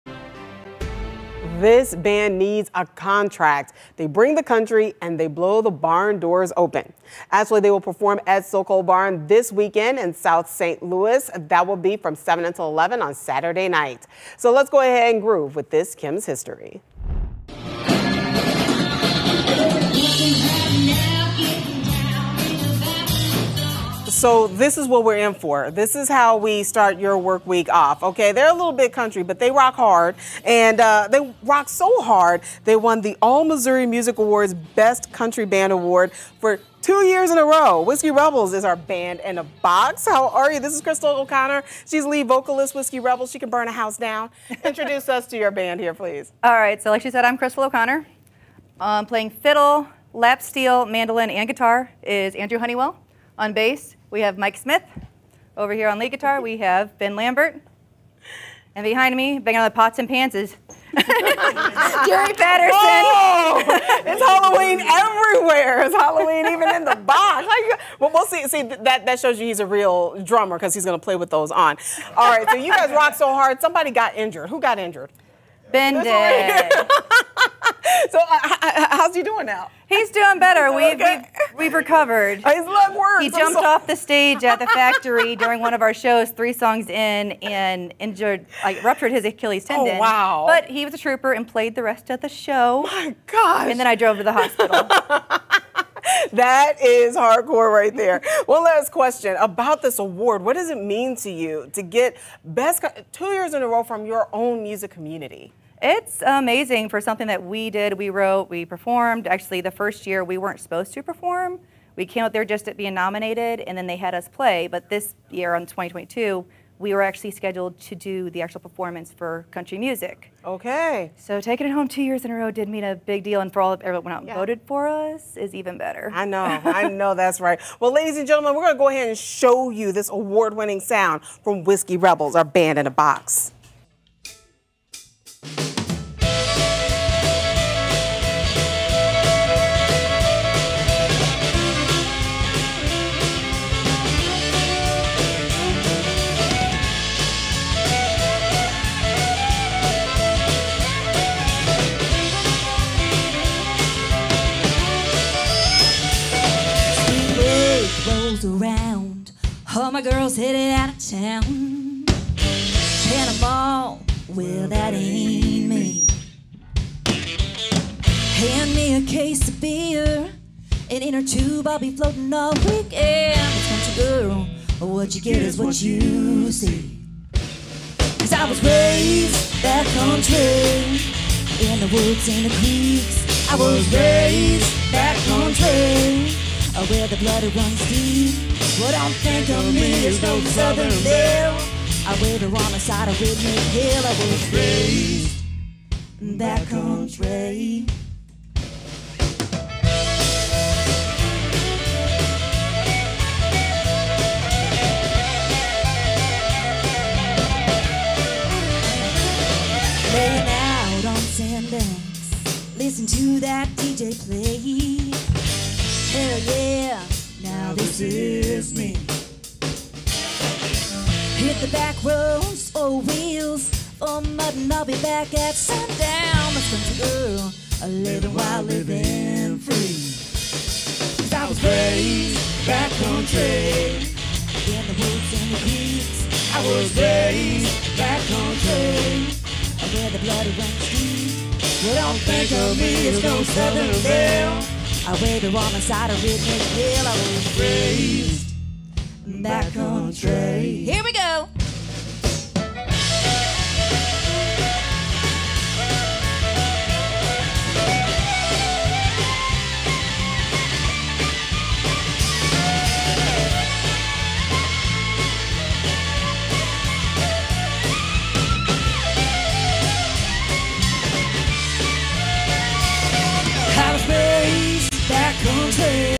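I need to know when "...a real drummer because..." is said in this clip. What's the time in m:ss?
1:09.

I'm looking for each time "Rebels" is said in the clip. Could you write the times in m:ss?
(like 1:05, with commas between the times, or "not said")
0:38, 0:42, 2:11.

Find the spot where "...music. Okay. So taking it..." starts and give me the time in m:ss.
1:59.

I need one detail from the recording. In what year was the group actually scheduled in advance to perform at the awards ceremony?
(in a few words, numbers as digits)
2022.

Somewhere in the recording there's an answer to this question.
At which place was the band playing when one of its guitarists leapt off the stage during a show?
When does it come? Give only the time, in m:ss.
1:24.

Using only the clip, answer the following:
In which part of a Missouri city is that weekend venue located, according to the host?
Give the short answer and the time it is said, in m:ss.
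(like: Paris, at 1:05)
South St. Louis, at 0:10.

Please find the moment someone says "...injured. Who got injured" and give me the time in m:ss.
1:14.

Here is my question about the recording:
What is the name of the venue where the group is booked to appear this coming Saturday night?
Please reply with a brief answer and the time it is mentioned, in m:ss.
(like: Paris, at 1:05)
Sokol Barn, at 0:08.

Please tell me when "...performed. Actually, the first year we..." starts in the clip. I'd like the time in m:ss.
1:48.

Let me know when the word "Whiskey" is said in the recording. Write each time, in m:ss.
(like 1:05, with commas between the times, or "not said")
0:37, 0:42, 2:11.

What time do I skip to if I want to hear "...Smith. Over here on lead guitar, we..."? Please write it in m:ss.
0:54.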